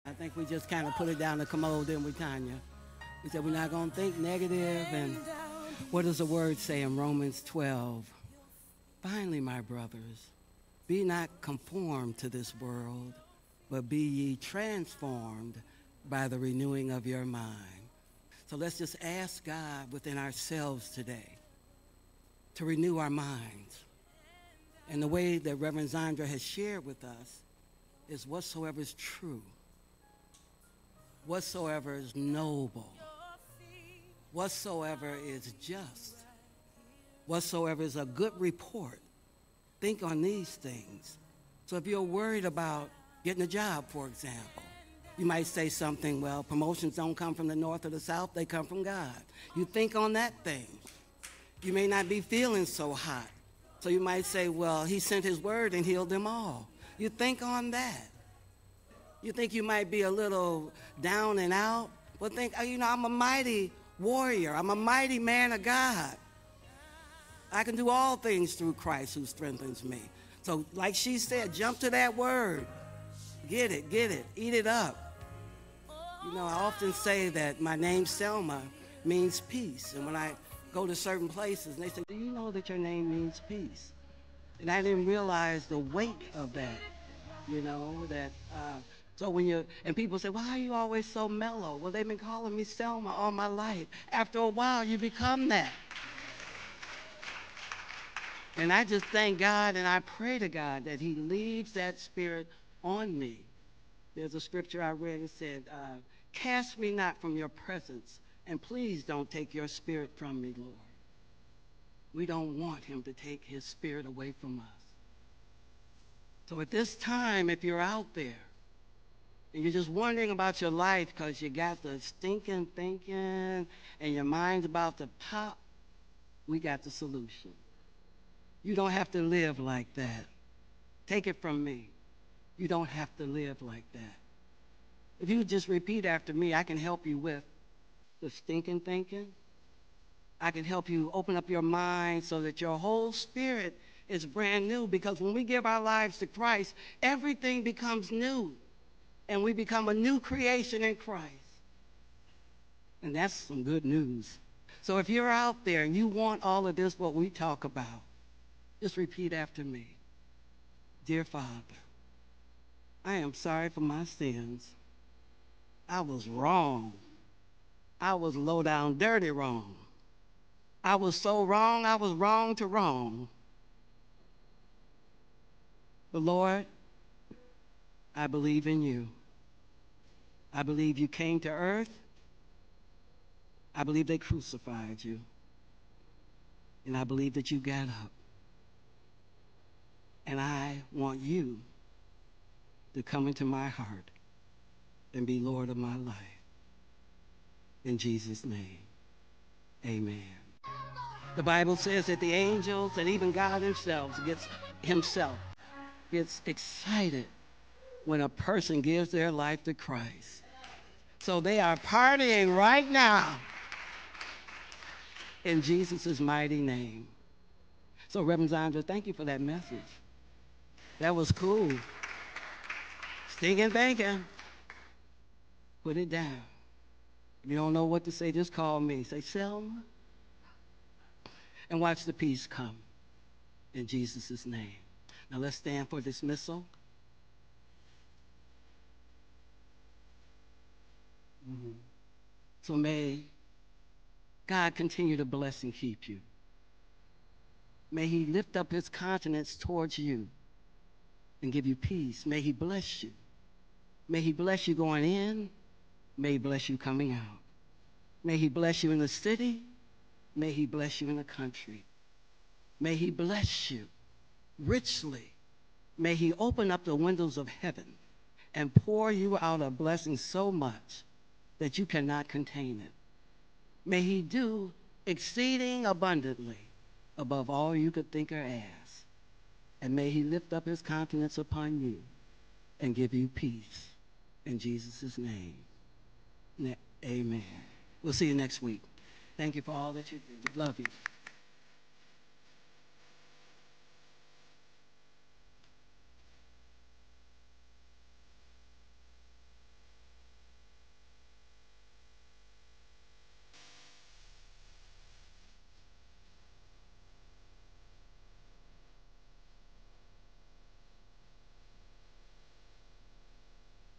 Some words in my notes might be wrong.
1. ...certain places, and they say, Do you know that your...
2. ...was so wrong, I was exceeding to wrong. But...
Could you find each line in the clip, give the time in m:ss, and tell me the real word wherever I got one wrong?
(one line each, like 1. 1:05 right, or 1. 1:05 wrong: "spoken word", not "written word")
1. 1:20 right
2. 2:50 wrong: "wrong", not "exceeding".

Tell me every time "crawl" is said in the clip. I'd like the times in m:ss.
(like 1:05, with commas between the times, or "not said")
not said.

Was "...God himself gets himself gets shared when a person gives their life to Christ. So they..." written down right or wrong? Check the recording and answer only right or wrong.
wrong.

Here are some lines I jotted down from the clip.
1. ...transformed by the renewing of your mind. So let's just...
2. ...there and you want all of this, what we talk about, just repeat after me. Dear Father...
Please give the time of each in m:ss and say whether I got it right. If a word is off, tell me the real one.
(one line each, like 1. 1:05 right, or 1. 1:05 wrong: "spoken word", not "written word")
1. 0:14 right
2. 2:35 right.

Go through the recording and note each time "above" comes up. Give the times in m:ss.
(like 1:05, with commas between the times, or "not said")
4:37.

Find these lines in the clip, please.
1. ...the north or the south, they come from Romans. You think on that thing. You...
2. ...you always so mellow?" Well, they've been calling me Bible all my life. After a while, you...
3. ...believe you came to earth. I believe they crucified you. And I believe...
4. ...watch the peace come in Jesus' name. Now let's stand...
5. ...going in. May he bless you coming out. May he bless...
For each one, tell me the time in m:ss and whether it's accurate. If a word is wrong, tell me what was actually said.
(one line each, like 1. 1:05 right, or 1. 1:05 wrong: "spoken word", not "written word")
1. 0:47 wrong: "God", not "Romans"
2. 1:30 wrong: "Selma", not "Bible"
3. 3:00 right
4. 3:51 right
5. 4:14 right.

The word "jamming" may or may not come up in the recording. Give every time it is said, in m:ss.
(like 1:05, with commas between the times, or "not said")
not said.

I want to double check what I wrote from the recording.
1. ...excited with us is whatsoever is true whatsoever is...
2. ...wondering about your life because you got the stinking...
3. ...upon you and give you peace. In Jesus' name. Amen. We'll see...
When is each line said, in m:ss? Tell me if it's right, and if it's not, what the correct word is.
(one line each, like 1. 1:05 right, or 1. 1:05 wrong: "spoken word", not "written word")
1. 0:26 wrong: "shared", not "excited"
2. 1:59 right
3. 4:41 right.